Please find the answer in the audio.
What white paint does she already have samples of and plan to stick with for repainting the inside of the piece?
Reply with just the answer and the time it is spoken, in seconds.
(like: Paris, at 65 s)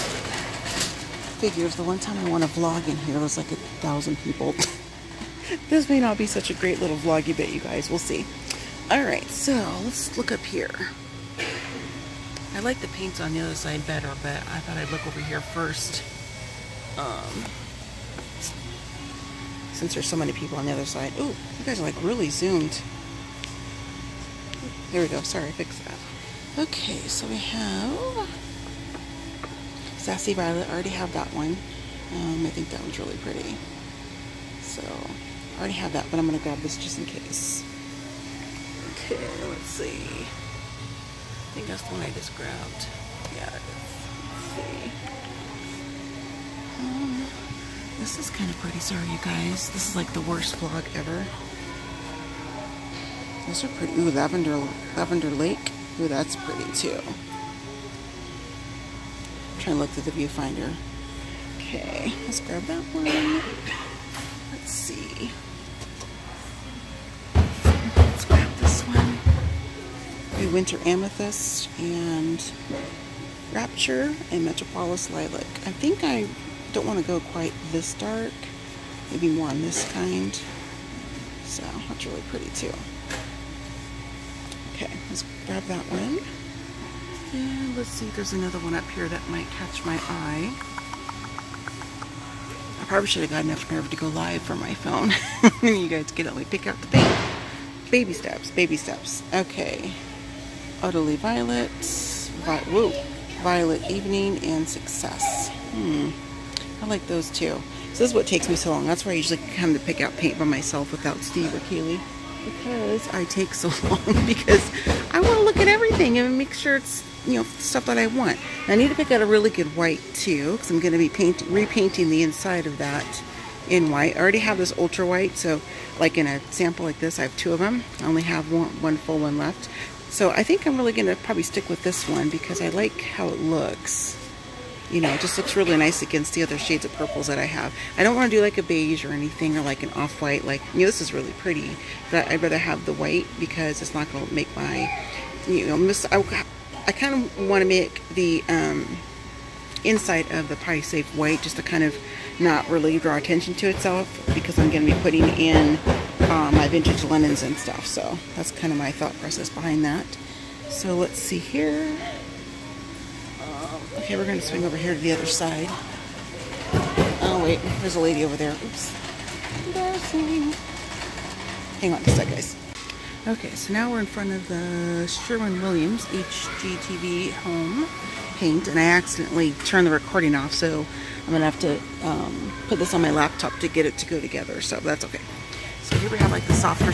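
ultra white, at 124 s.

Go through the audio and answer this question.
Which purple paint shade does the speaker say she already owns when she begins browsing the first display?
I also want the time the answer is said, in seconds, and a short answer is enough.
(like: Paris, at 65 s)
Sassy Violet, at 30 s.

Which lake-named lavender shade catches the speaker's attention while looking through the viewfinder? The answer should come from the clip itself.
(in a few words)
Lavender Lake.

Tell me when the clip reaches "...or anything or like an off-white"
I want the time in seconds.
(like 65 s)
139 s.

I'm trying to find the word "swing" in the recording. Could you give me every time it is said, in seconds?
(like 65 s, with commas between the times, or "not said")
164 s.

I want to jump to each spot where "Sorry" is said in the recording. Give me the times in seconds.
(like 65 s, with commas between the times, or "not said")
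25 s, 48 s.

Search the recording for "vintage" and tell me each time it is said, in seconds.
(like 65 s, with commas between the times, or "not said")
156 s.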